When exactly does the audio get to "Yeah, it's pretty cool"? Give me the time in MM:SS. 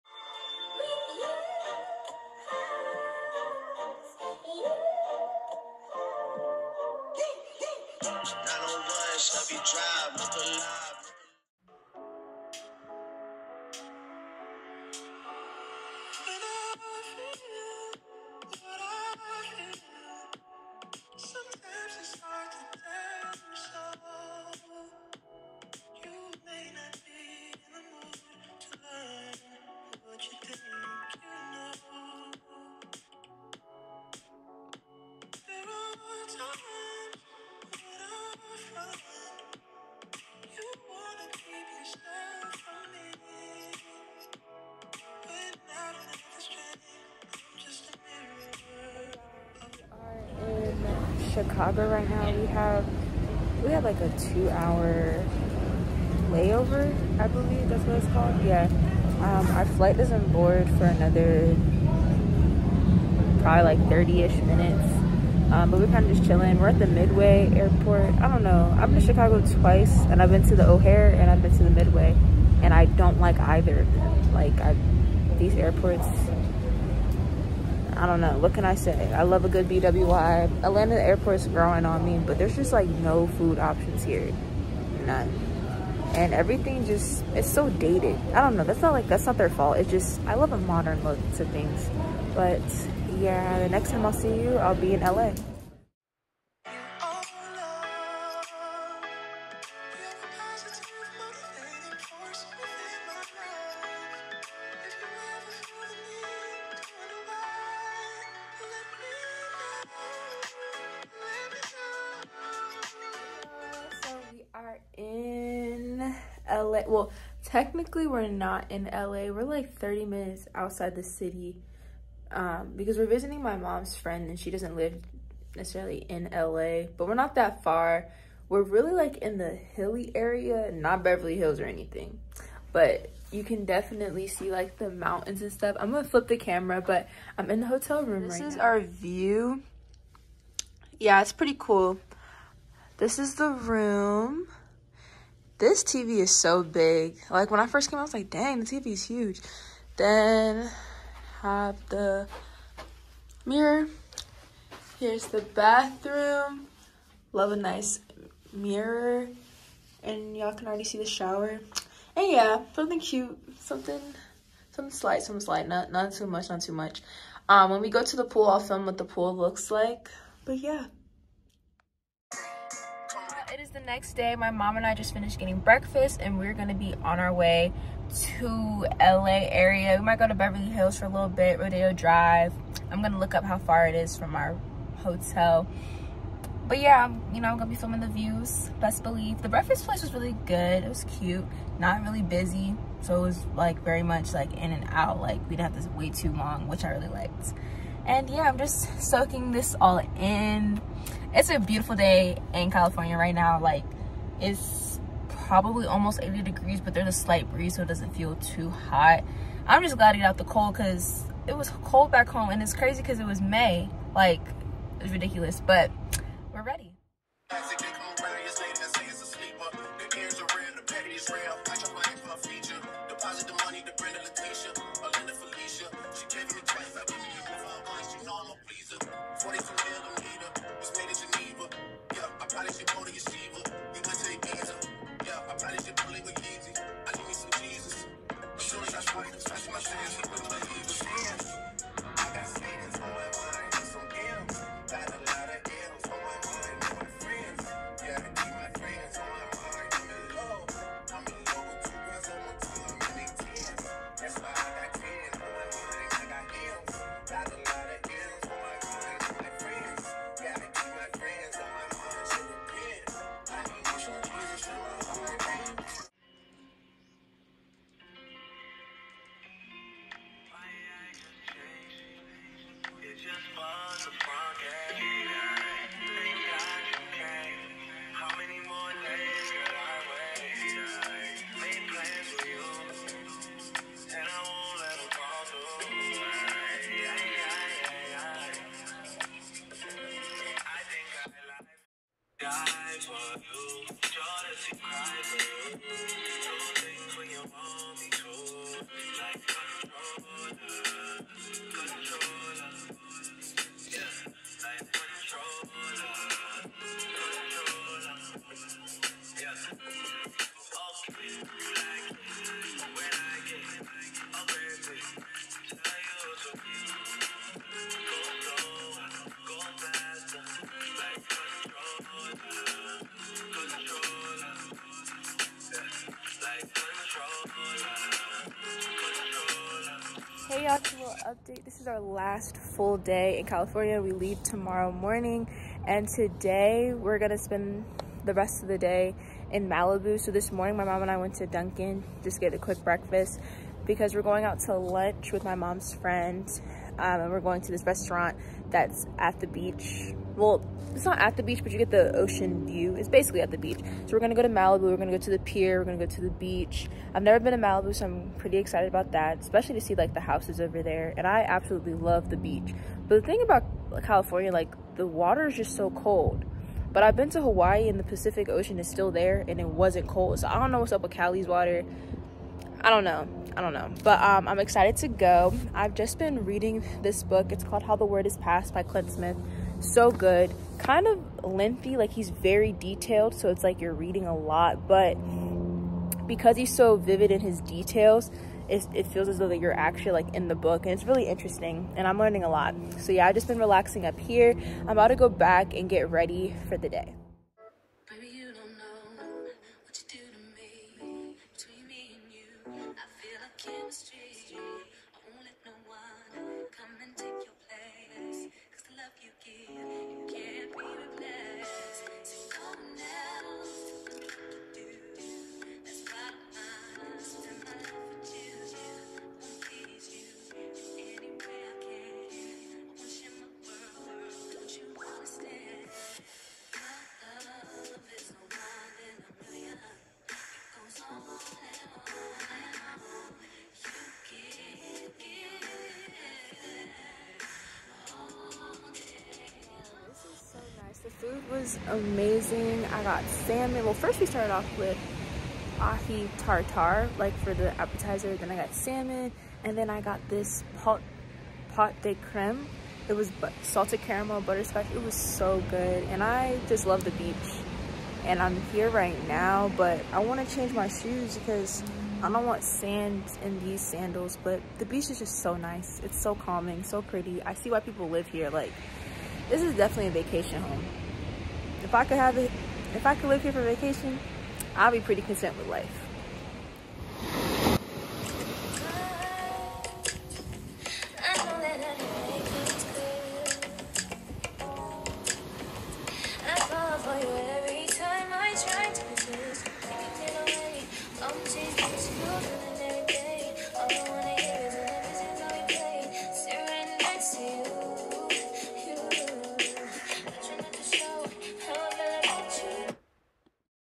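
02:20.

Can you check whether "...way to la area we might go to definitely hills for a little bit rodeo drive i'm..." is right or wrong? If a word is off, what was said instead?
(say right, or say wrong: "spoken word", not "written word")
wrong: "beverly", not "definitely".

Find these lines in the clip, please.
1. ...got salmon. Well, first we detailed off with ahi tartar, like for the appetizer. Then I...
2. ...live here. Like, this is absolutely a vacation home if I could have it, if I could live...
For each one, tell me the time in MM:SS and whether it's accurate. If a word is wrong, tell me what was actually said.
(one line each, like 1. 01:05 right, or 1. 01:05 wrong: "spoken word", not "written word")
1. 07:23 wrong: "started", not "detailed"
2. 07:48 wrong: "definitely", not "absolutely".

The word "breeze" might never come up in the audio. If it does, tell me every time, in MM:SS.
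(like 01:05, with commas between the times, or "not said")
03:27.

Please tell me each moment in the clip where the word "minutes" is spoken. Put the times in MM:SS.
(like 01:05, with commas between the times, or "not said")
01:04, 02:00.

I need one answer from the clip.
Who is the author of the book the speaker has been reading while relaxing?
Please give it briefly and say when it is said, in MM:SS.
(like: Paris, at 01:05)
Clint Smith, at 06:18.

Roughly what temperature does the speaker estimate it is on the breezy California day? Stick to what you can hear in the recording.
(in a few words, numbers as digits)
80 degrees.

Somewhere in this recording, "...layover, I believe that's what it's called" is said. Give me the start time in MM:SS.
00:56.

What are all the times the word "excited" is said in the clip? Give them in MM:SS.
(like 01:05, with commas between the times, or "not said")
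05:58, 06:14.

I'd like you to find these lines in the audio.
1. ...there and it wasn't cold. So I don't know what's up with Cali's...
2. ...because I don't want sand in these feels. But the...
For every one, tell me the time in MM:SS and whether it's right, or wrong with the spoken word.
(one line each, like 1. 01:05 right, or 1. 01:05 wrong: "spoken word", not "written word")
1. 06:09 right
2. 07:41 wrong: "sandals", not "feels".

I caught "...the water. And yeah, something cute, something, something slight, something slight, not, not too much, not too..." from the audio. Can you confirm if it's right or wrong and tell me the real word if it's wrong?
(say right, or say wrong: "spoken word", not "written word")
wrong: "shower", not "water".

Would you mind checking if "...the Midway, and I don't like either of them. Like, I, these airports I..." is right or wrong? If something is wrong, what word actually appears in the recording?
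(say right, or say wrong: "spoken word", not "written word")
right.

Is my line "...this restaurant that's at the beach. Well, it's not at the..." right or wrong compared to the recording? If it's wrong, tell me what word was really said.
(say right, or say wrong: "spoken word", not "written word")
right.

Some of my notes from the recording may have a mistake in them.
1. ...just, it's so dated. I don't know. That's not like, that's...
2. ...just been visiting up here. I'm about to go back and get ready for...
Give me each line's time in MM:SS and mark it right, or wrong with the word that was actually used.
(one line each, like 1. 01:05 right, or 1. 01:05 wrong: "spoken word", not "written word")
1. 01:26 right
2. 06:33 wrong: "relaxing", not "visiting".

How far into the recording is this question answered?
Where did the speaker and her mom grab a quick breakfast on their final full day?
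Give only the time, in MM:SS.
05:41.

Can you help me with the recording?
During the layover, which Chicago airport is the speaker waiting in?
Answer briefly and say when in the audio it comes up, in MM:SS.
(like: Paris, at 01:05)
Midway Airport, at 01:06.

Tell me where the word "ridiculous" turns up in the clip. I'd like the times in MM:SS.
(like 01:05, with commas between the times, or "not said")
03:35.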